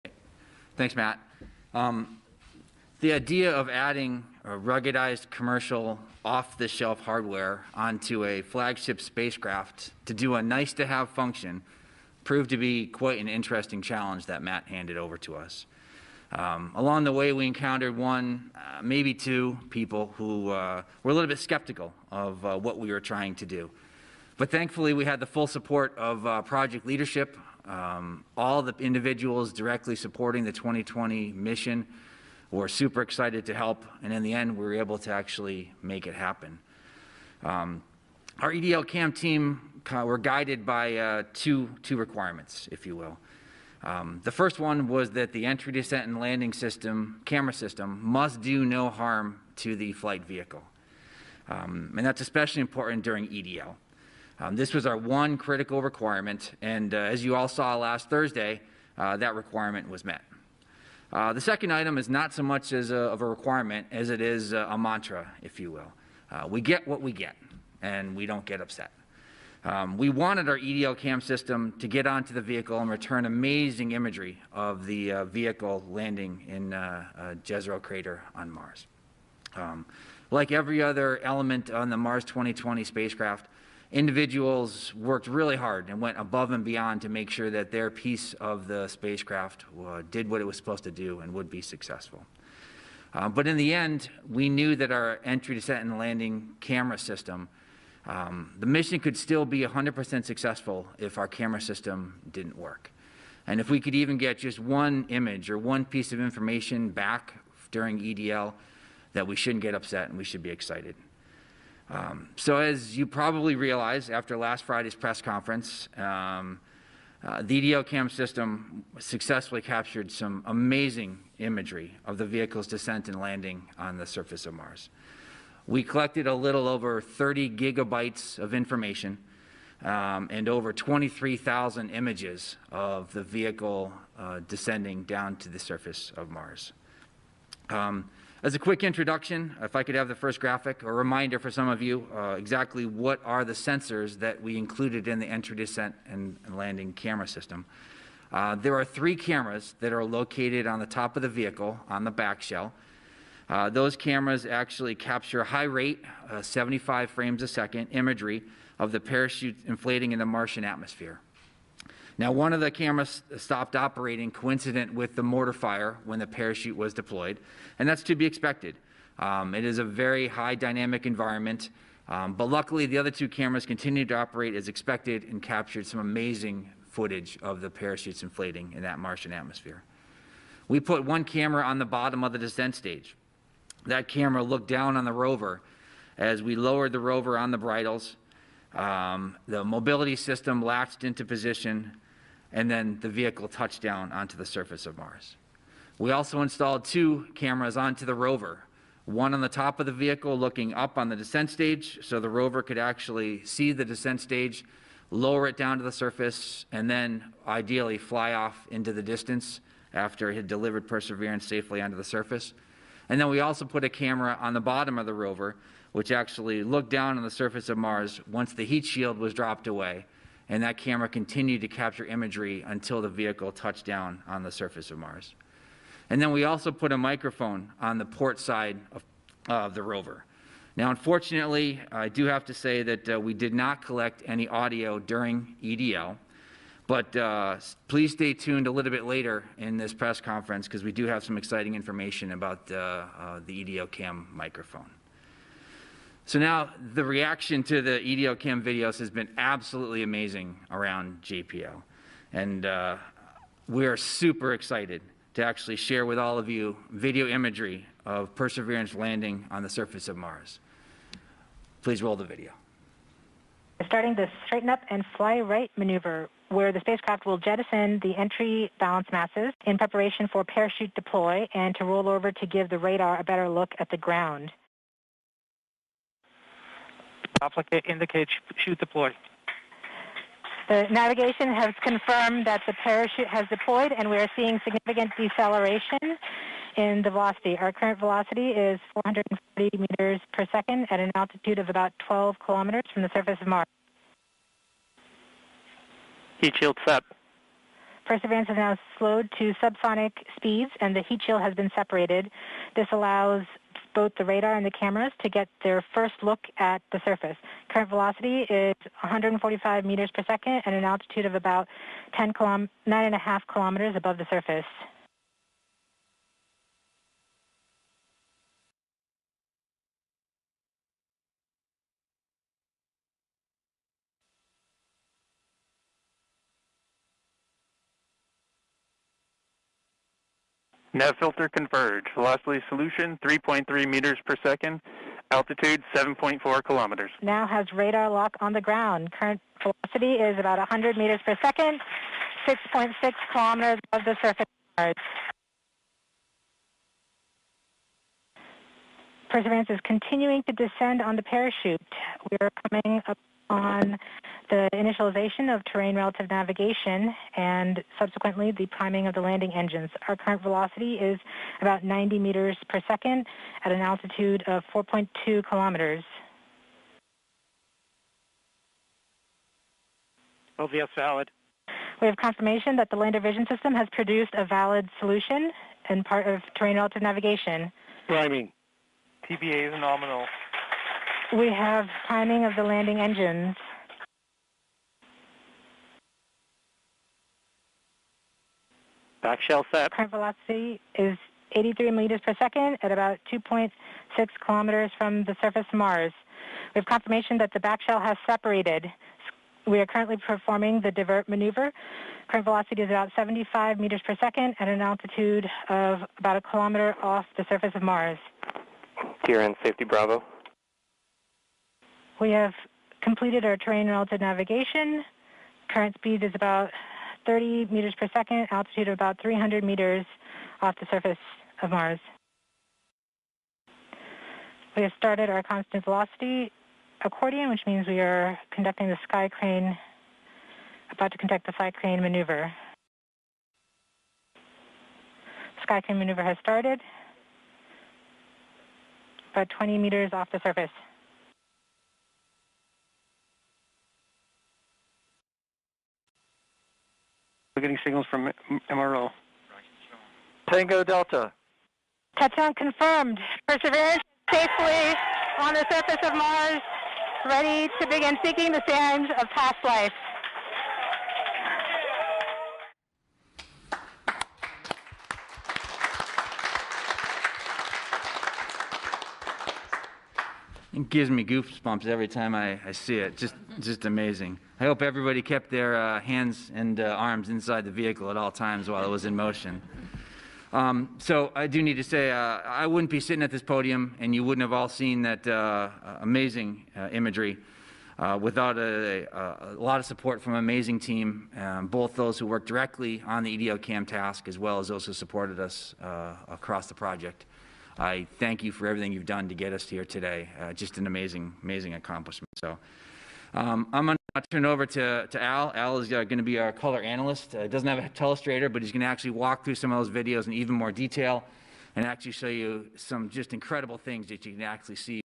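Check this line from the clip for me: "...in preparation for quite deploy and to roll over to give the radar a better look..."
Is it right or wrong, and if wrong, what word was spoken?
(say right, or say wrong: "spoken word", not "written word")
wrong: "parachute", not "quite".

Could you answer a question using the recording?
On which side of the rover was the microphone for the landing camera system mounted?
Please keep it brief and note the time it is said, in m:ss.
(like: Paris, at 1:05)
port side, at 3:48.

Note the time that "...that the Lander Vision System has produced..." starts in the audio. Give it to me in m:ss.
6:12.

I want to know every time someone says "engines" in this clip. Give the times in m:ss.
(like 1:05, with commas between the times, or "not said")
5:59, 6:22.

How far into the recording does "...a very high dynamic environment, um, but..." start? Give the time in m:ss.
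2:49.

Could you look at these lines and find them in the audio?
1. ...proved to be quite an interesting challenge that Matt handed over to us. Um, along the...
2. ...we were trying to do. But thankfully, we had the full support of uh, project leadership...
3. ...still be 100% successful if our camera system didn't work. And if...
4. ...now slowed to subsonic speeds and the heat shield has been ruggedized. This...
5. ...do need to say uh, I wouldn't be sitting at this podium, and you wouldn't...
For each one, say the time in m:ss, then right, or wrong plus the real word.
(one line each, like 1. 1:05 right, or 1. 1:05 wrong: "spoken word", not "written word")
1. 0:12 right
2. 0:22 right
3. 1:39 right
4. 4:58 wrong: "separated", not "ruggedized"
5. 8:01 right.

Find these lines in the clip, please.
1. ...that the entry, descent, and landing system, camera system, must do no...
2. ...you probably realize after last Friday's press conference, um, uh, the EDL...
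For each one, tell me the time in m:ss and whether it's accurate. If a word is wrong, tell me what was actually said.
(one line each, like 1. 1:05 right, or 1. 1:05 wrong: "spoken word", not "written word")
1. 0:45 right
2. 1:52 right.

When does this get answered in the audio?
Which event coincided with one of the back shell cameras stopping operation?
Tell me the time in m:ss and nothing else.
2:45.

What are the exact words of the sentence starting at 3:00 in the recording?
We put one camera on the bottom of the descent stage.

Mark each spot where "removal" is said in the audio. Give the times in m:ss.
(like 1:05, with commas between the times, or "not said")
not said.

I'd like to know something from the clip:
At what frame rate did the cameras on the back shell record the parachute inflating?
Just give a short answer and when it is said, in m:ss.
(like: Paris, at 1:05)
75 frames a second, at 2:36.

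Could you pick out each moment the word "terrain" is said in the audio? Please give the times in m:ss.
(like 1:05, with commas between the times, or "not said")
5:55, 6:16, 6:53.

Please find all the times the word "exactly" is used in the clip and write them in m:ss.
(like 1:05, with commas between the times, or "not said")
2:22.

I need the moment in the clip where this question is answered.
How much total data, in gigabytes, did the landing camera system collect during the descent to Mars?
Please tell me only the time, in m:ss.
2:06.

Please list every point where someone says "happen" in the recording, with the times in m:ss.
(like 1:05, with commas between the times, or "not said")
0:36.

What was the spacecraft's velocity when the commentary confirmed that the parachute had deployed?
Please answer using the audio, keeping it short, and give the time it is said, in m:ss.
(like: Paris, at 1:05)
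440 meters per second, at 4:48.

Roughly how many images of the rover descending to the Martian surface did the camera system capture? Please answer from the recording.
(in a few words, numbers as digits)
over 23,000.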